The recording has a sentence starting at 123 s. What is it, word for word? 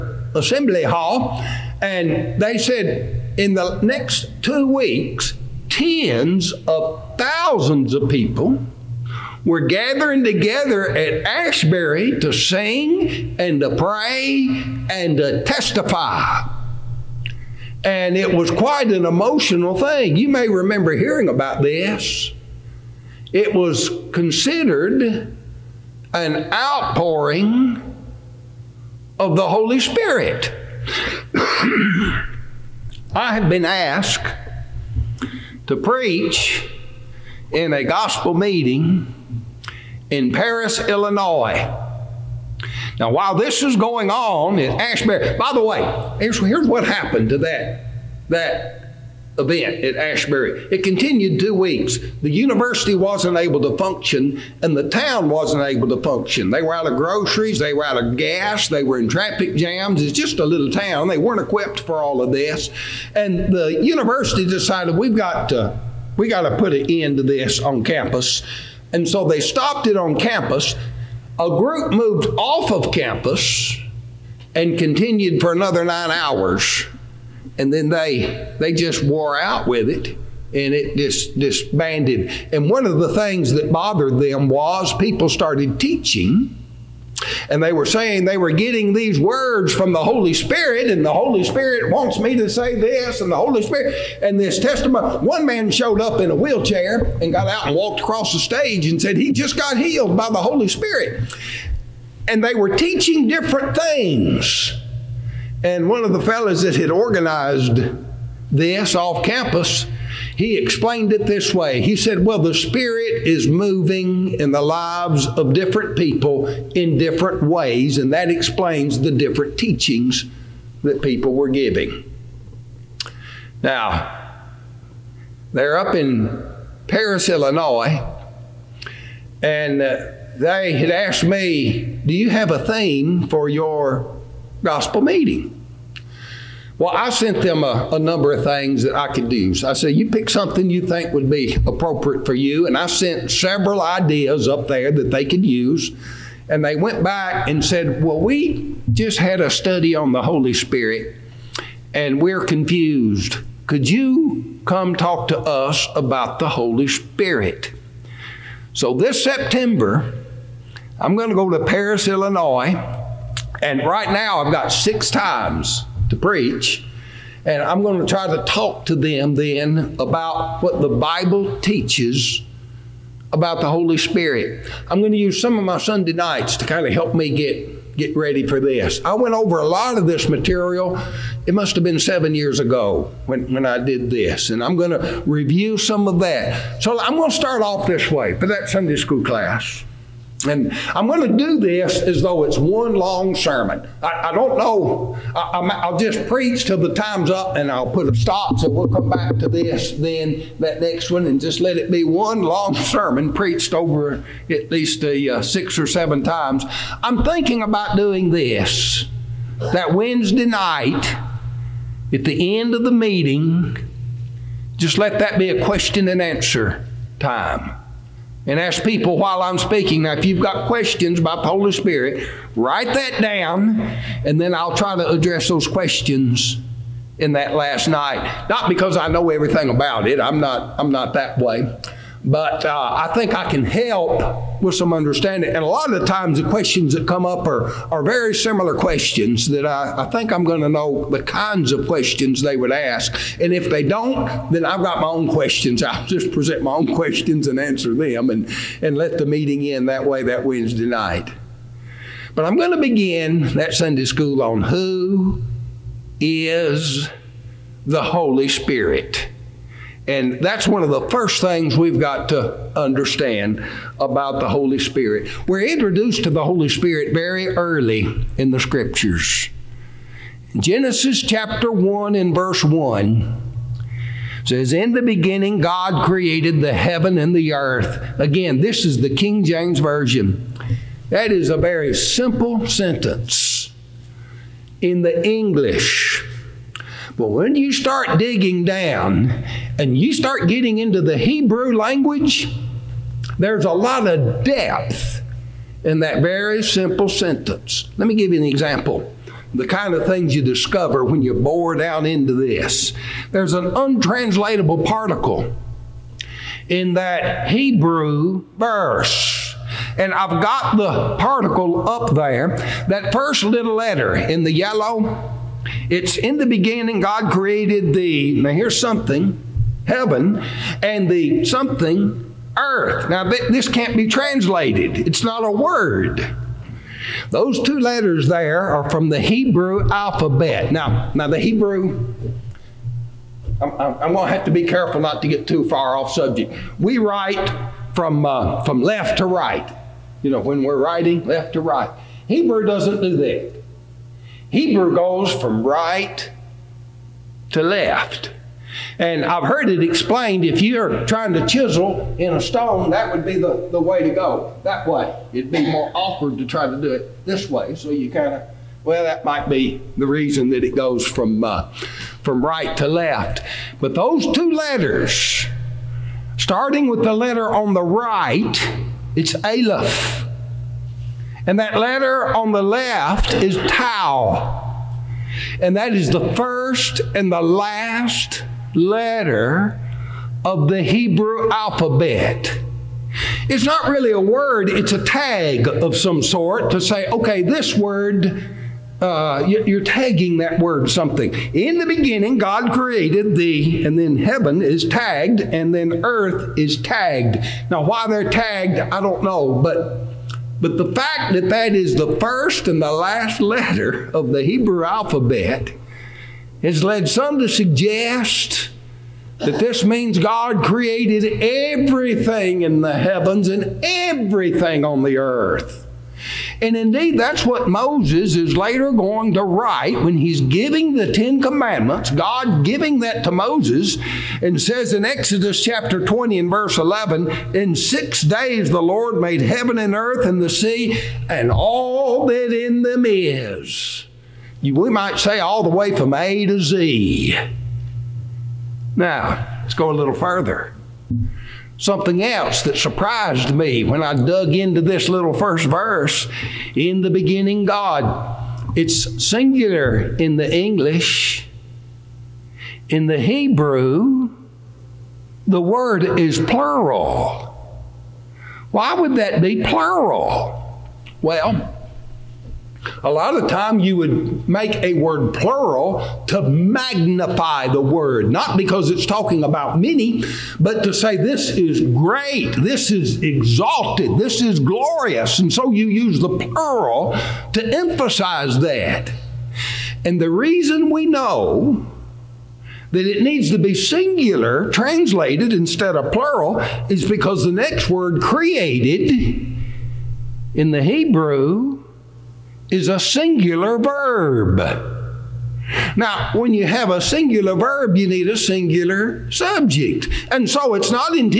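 Now, they're up in Paris, Illinois, and uh, they had asked me, Do you have a theme for your gospel meeting.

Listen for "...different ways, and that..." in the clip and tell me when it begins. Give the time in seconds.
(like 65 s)
116 s.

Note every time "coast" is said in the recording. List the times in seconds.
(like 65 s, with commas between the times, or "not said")
not said.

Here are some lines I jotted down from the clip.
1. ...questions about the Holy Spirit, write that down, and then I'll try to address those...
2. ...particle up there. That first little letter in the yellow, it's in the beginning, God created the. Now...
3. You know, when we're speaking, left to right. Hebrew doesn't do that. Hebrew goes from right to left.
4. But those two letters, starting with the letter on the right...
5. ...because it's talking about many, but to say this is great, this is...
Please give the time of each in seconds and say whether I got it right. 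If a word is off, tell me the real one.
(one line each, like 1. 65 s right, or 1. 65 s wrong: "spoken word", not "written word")
1. 220 s right
2. 311 s right
3. 340 s wrong: "writing", not "speaking"
4. 363 s right
5. 468 s right.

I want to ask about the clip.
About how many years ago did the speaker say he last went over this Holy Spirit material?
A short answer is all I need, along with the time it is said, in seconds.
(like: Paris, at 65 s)
7, at 181 s.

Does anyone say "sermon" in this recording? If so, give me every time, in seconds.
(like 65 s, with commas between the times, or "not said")
193 s, 202 s.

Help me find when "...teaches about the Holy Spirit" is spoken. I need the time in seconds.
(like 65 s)
171 s.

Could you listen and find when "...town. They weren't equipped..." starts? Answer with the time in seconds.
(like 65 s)
60 s.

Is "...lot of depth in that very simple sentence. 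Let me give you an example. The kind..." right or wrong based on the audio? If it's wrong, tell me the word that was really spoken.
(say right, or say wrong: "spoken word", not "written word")
right.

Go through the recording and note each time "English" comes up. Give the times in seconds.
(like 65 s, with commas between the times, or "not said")
285 s, 450 s.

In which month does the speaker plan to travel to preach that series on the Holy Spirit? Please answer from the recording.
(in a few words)
September.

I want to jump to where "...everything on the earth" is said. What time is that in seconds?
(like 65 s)
413 s.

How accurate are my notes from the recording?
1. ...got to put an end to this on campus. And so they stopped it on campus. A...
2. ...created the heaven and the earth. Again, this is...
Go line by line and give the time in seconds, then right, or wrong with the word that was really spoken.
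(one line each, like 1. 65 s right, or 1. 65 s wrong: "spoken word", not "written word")
1. 66 s right
2. 276 s right.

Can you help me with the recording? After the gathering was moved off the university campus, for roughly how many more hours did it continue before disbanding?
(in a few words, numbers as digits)
9.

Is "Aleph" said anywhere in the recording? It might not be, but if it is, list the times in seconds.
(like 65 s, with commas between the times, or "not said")
369 s.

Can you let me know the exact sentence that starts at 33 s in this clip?
I have been asked to preach in a gospel meeting in Paris, Illinois.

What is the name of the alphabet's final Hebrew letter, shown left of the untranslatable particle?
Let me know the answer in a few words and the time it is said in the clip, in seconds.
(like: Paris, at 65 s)
Tau, at 373 s.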